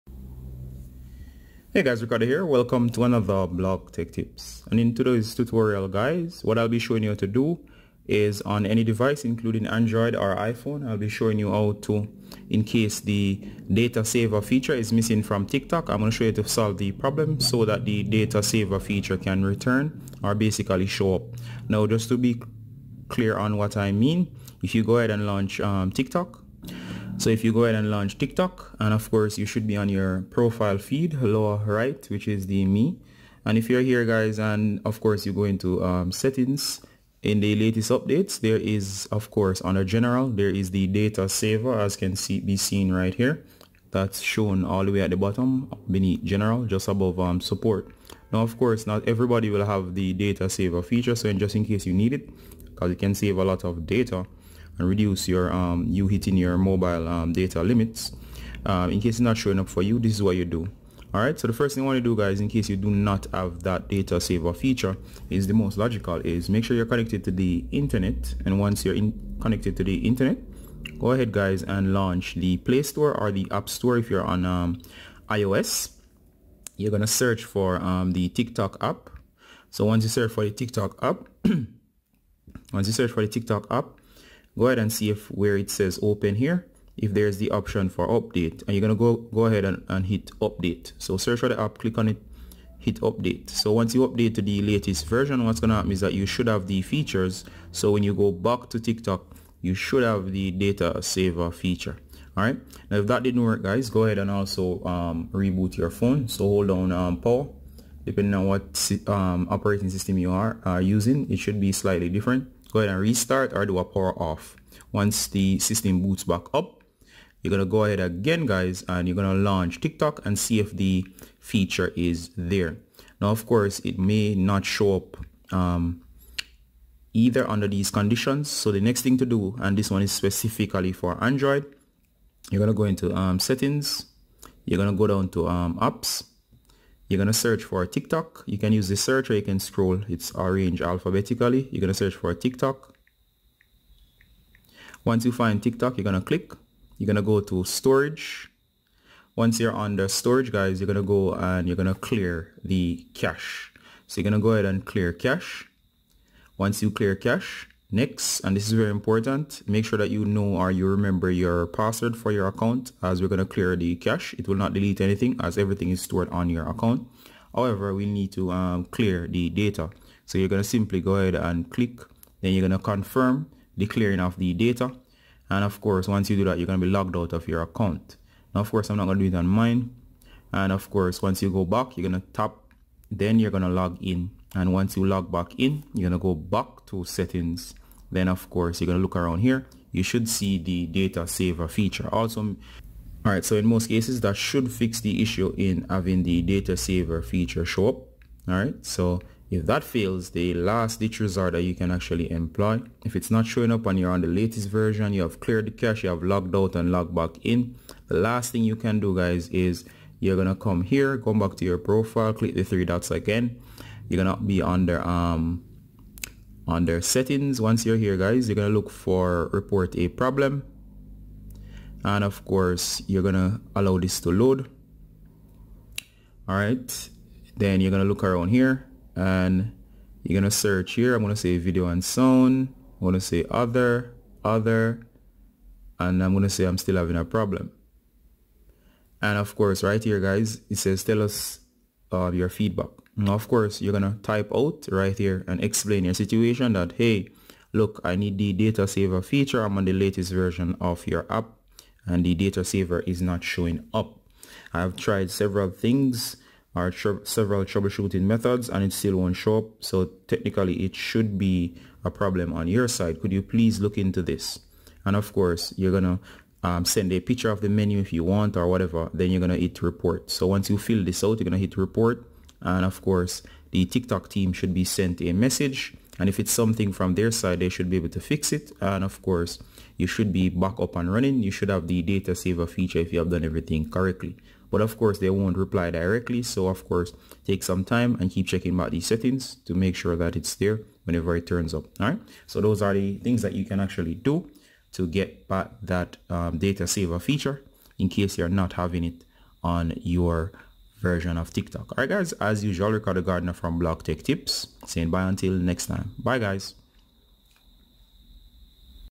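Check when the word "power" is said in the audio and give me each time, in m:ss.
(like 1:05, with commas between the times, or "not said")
1:47, 1:53.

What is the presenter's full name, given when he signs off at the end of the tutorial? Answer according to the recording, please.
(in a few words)
Ricardo Gardener.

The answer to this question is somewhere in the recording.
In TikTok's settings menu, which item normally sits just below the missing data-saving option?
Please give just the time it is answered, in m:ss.
0:47.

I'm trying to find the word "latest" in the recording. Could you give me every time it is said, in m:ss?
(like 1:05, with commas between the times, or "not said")
0:37, 1:34, 3:24, 4:09.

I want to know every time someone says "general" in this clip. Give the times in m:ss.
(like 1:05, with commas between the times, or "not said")
0:39, 0:46.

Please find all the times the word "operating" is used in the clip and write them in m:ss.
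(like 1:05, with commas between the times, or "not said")
1:49.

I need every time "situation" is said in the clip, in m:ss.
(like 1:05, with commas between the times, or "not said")
4:06.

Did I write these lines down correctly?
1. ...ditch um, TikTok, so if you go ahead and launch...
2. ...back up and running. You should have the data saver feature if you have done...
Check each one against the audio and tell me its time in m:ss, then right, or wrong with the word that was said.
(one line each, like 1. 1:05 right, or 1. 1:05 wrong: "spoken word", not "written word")
1. 0:25 wrong: "launch", not "ditch"
2. 4:40 right.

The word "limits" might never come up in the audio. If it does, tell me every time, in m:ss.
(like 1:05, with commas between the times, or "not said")
0:57.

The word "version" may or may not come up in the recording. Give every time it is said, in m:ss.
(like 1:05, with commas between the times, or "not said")
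1:35, 3:24, 4:10, 5:01.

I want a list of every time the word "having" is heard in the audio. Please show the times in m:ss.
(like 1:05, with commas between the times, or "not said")
3:15, 3:56, 4:58.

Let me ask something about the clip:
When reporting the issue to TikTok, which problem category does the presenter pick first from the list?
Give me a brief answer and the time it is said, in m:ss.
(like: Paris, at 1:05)
Video and sound, at 3:51.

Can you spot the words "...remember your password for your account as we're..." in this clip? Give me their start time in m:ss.
2:40.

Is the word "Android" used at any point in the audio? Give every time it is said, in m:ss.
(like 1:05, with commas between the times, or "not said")
0:09, 2:11.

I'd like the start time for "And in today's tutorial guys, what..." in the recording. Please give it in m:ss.
0:04.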